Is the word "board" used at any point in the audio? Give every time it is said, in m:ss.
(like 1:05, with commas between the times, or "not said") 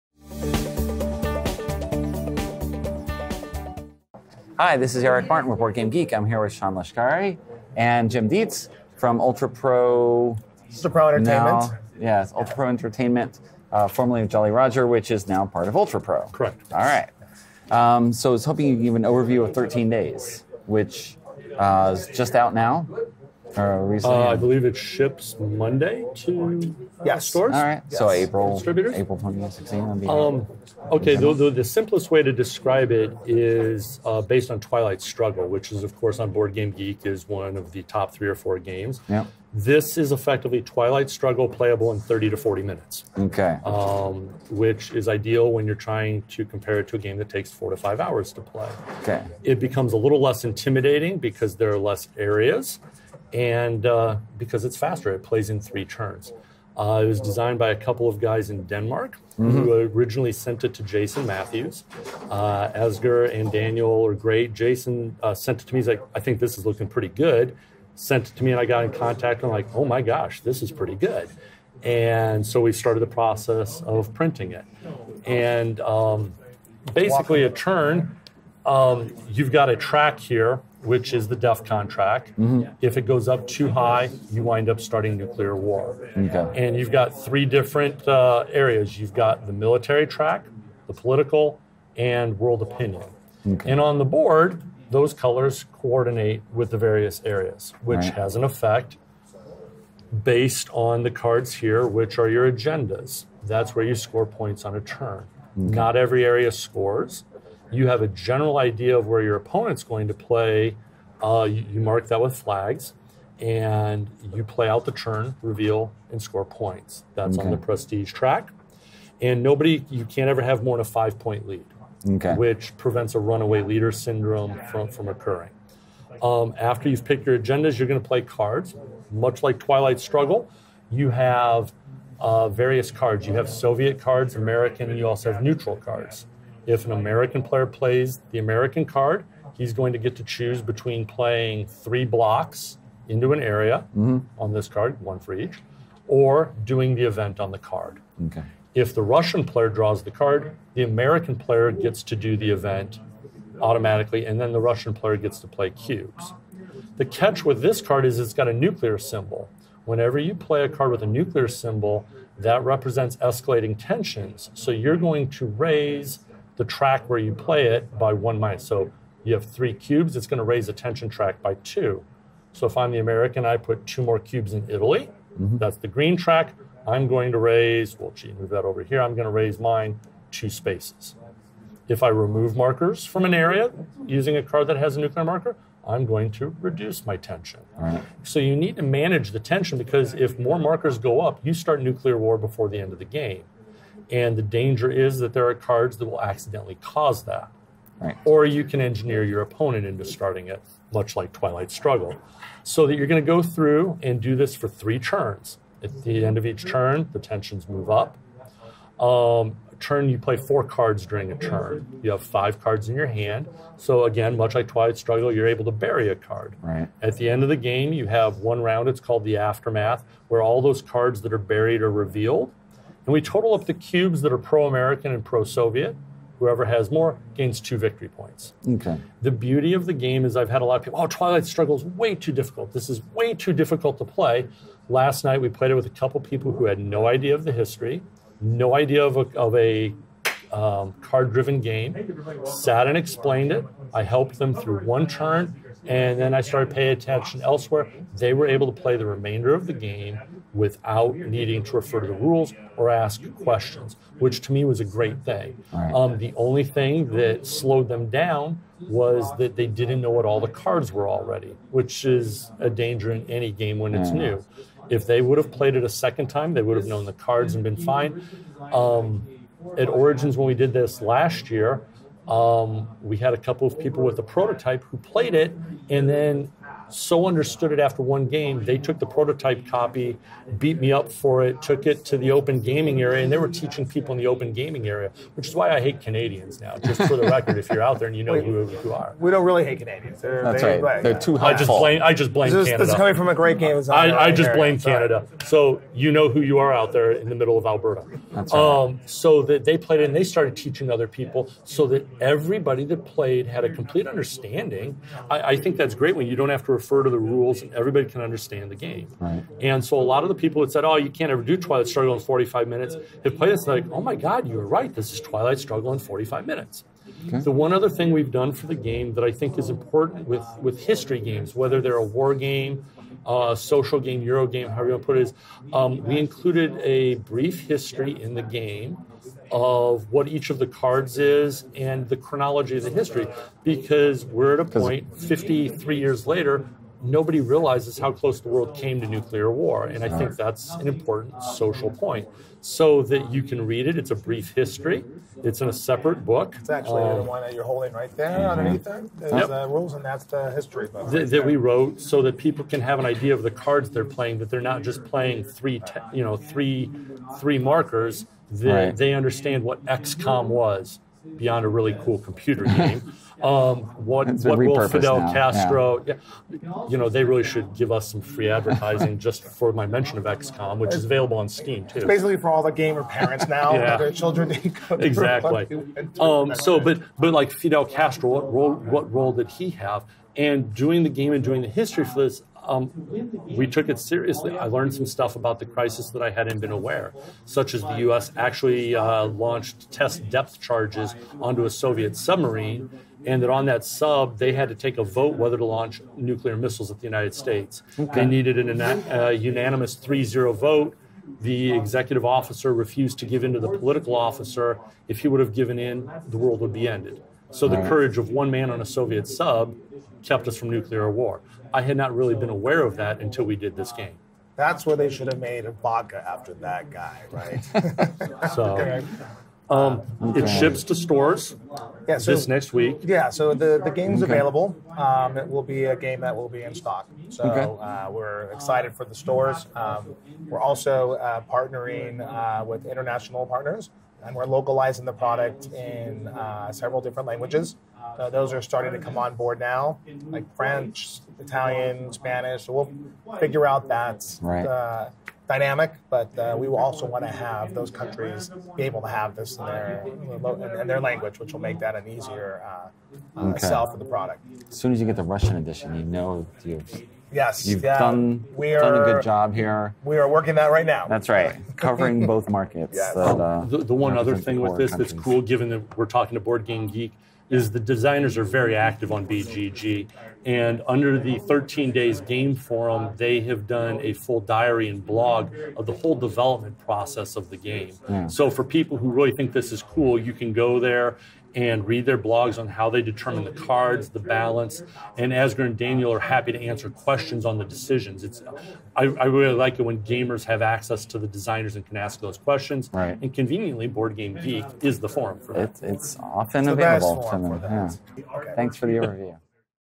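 0:05, 0:36, 1:34, 7:19, 7:46, 8:13.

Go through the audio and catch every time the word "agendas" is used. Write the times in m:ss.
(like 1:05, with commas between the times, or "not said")
1:42, 2:07.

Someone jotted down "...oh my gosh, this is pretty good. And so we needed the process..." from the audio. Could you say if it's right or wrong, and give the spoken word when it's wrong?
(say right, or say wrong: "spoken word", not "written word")
wrong: "started", not "needed".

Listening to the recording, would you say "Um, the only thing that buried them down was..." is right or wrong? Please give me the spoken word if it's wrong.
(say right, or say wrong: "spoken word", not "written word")
wrong: "slowed", not "buried".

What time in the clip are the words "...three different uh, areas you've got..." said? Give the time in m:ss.
1:27.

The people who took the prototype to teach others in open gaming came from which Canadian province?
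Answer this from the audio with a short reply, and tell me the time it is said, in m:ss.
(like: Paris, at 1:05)
Alberta, at 4:57.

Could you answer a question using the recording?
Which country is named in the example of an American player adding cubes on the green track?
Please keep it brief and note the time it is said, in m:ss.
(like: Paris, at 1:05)
Italy, at 2:54.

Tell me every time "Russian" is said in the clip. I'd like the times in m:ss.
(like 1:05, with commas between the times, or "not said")
2:29, 2:34, 7:35.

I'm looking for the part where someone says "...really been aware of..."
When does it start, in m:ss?
6:52.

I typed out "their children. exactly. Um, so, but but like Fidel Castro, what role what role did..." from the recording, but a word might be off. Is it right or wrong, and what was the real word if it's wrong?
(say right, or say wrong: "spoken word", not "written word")
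right.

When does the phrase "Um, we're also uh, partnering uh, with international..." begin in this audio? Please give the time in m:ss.
7:09.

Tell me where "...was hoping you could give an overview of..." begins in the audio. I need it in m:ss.
0:18.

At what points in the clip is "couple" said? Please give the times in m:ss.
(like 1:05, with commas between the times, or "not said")
0:57, 3:55, 4:33.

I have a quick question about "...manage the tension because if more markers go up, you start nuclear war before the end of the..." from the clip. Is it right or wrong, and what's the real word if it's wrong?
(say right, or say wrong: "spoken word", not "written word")
right.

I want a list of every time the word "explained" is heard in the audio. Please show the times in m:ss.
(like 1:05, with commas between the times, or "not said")
4:02.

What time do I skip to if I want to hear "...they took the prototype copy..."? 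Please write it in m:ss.
4:38.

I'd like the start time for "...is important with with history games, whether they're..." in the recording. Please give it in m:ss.
5:19.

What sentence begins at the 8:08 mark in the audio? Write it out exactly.
It's I, I really like it when gamers have access to the designers and can ask those questions.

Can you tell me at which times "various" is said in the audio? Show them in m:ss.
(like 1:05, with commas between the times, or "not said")
1:36, 2:12.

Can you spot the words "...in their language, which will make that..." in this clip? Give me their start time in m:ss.
7:30.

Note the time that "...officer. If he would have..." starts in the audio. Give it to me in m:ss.
6:44.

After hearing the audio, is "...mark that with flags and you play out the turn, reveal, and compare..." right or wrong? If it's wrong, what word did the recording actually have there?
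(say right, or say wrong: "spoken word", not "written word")
wrong: "score", not "compare".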